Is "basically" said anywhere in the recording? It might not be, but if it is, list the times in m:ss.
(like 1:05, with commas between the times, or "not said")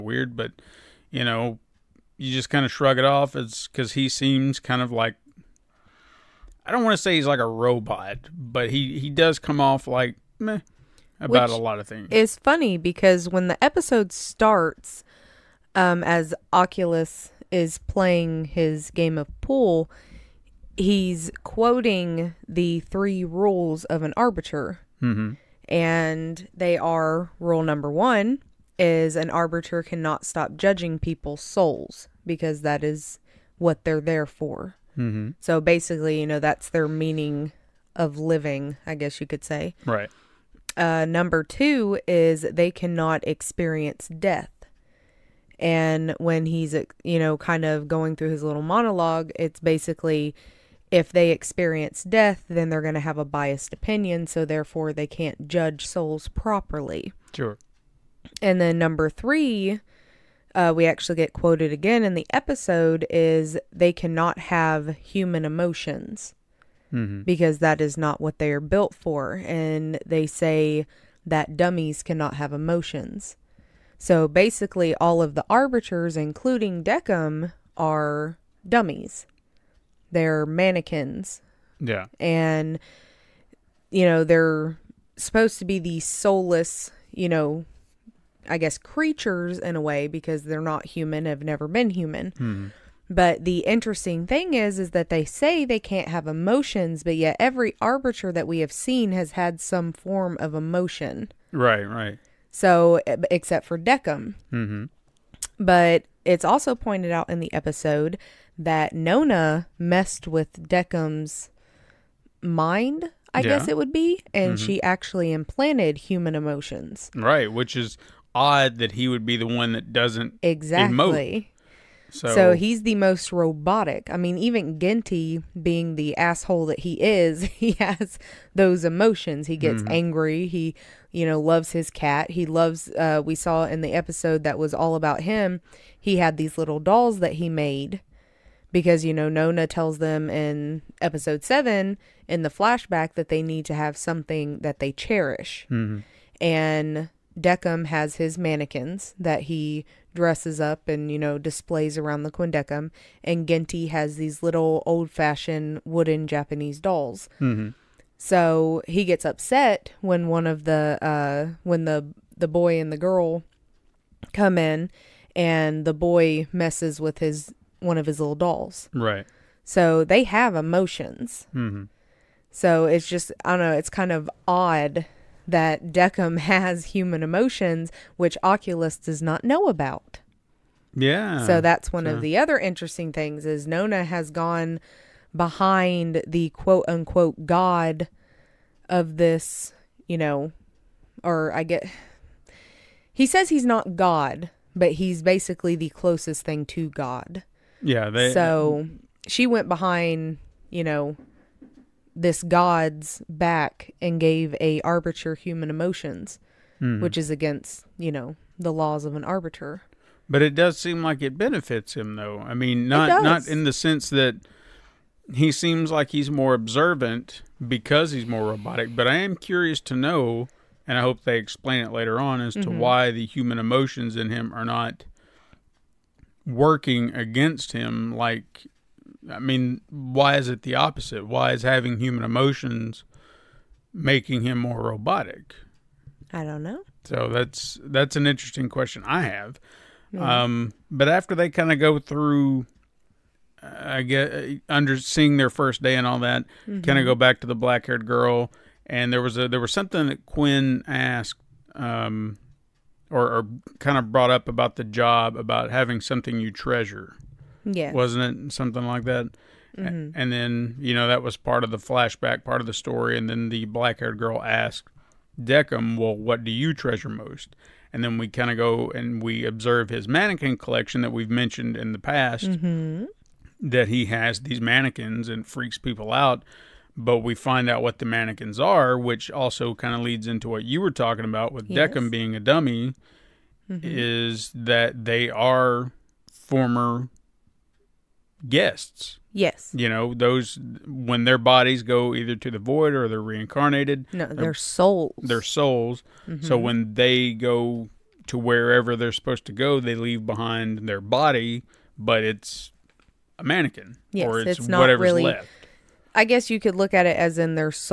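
0:35, 0:49, 1:14, 3:15.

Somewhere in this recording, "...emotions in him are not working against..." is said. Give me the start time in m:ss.
3:43.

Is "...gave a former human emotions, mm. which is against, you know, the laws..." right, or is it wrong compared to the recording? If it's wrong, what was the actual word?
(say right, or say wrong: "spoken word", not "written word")
wrong: "arbiter", not "former".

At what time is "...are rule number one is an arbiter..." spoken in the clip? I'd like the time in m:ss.
0:26.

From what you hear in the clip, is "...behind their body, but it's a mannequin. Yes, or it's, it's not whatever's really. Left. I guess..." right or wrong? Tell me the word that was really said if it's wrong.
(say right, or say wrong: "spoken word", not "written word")
right.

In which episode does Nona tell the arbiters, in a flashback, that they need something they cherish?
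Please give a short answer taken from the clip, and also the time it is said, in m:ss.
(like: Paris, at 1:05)
Episode 7, at 2:21.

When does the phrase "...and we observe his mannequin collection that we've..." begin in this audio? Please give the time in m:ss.
4:28.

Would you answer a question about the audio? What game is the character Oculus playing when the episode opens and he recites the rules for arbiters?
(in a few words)
Pool.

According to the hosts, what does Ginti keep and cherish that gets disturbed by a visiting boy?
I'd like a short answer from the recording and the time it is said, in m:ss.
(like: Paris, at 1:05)
Wooden Japanese dolls, at 2:35.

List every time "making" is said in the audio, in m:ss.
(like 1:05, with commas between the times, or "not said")
3:53.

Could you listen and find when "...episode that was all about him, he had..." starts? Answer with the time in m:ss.
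2:13.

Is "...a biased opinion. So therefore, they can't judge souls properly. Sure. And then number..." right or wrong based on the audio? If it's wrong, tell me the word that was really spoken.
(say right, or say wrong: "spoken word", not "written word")
right.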